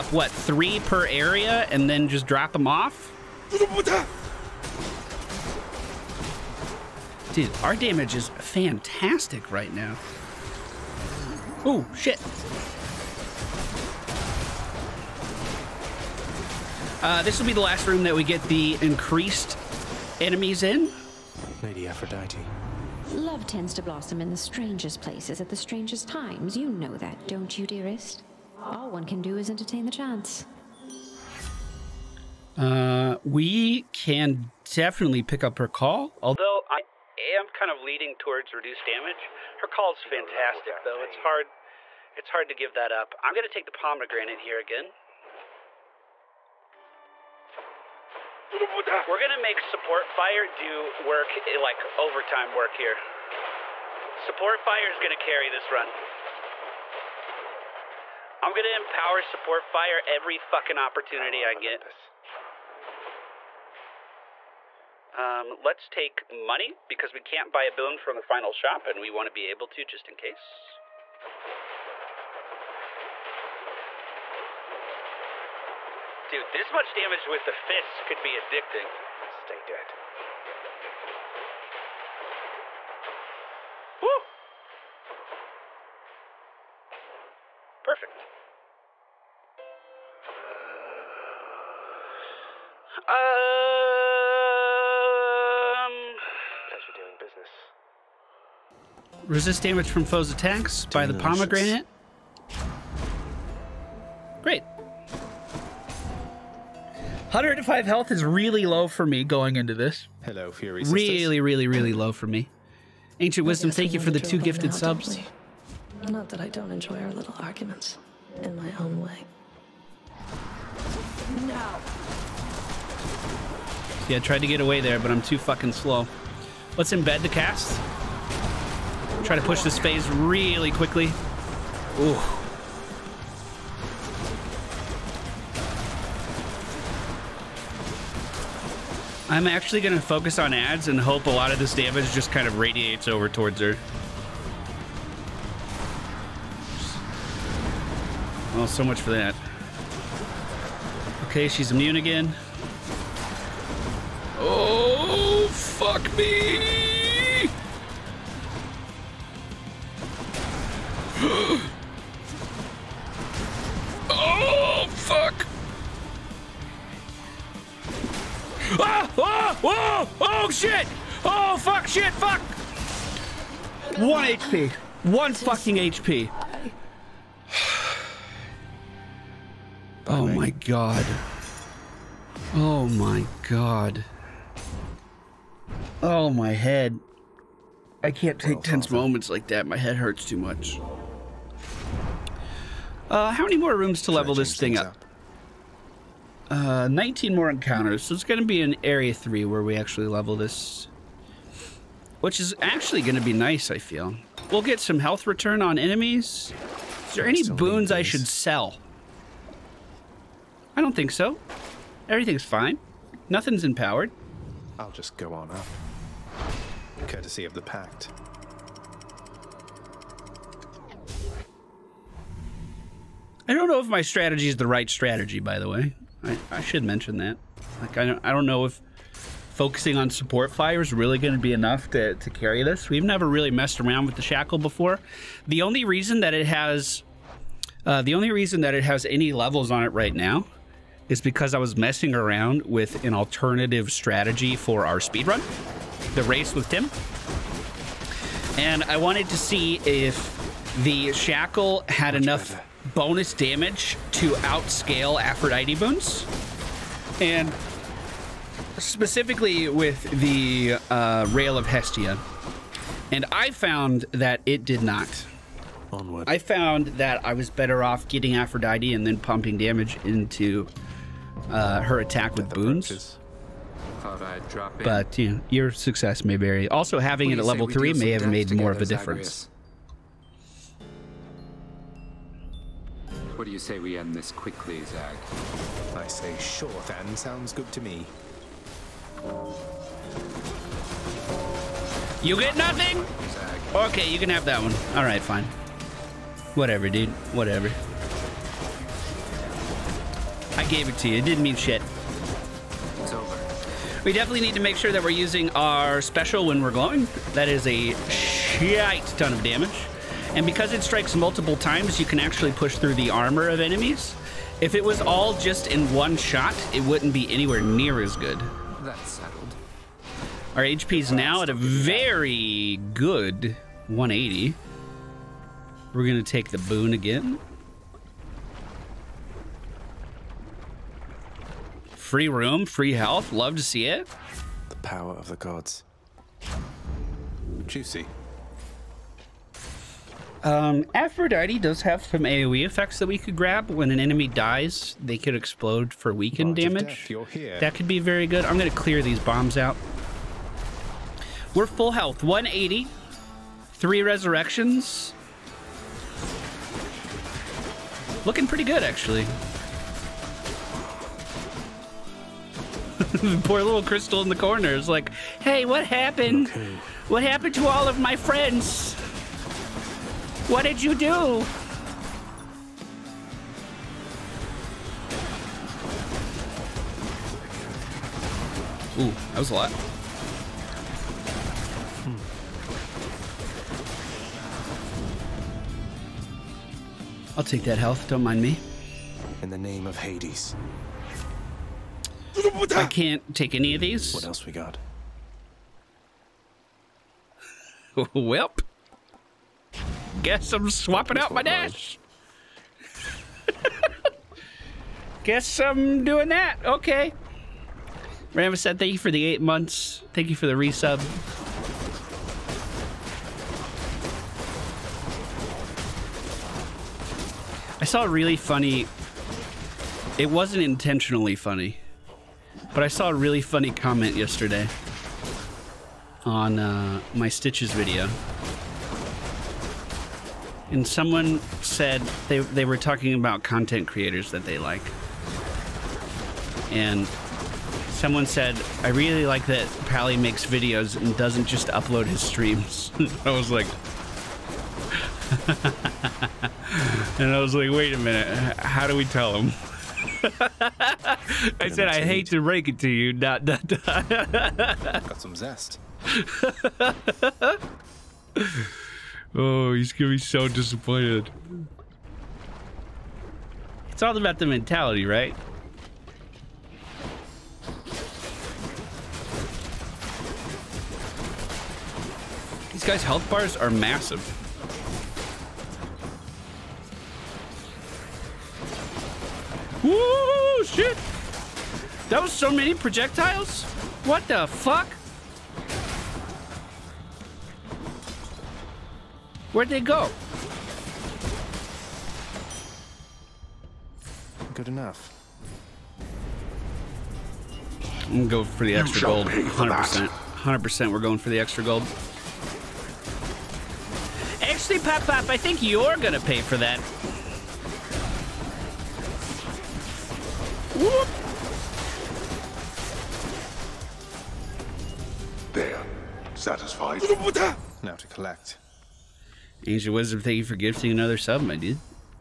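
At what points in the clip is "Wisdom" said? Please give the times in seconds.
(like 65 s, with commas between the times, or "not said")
113 s, 519 s.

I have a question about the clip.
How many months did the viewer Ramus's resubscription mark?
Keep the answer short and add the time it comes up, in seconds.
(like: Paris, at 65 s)
8, at 409 s.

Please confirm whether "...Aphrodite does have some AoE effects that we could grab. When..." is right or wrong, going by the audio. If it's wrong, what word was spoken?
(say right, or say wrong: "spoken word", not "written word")
right.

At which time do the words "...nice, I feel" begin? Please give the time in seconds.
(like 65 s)
203 s.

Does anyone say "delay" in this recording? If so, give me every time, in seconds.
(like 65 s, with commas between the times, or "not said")
not said.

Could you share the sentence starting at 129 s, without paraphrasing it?
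Try to push this phase really quickly.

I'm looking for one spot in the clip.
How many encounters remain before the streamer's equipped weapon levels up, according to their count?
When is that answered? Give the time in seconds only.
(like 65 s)
196 s.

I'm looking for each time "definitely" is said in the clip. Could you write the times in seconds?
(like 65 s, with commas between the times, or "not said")
34 s, 304 s.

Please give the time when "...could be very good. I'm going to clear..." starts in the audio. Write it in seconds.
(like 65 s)
347 s.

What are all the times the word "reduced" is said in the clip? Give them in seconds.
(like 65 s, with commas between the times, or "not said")
38 s.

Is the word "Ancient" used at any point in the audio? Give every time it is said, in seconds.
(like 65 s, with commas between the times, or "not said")
113 s, 519 s.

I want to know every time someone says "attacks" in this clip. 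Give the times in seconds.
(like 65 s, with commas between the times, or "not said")
100 s, 272 s.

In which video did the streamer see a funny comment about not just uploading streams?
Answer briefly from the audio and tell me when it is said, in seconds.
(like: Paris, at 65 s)
Stitches video, at 427 s.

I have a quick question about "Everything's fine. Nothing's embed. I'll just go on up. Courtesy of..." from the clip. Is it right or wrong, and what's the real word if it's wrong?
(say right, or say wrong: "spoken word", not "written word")
wrong: "empowered", not "embed".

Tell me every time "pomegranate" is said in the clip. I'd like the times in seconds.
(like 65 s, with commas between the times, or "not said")
43 s, 101 s.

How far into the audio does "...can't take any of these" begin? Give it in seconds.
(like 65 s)
392 s.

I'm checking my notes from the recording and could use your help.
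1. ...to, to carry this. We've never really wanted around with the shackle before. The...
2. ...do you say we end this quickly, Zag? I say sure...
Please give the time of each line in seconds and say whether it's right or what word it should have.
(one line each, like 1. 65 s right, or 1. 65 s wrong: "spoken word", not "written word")
1. 231 s wrong: "messed", not "wanted"
2. 283 s right.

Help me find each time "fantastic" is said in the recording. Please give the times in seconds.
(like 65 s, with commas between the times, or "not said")
8 s, 40 s.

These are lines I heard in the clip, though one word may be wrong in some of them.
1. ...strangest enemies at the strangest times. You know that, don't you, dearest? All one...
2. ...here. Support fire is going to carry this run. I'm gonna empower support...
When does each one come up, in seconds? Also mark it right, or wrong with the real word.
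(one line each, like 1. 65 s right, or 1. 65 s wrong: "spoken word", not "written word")
1. 24 s wrong: "places", not "enemies"
2. 52 s right.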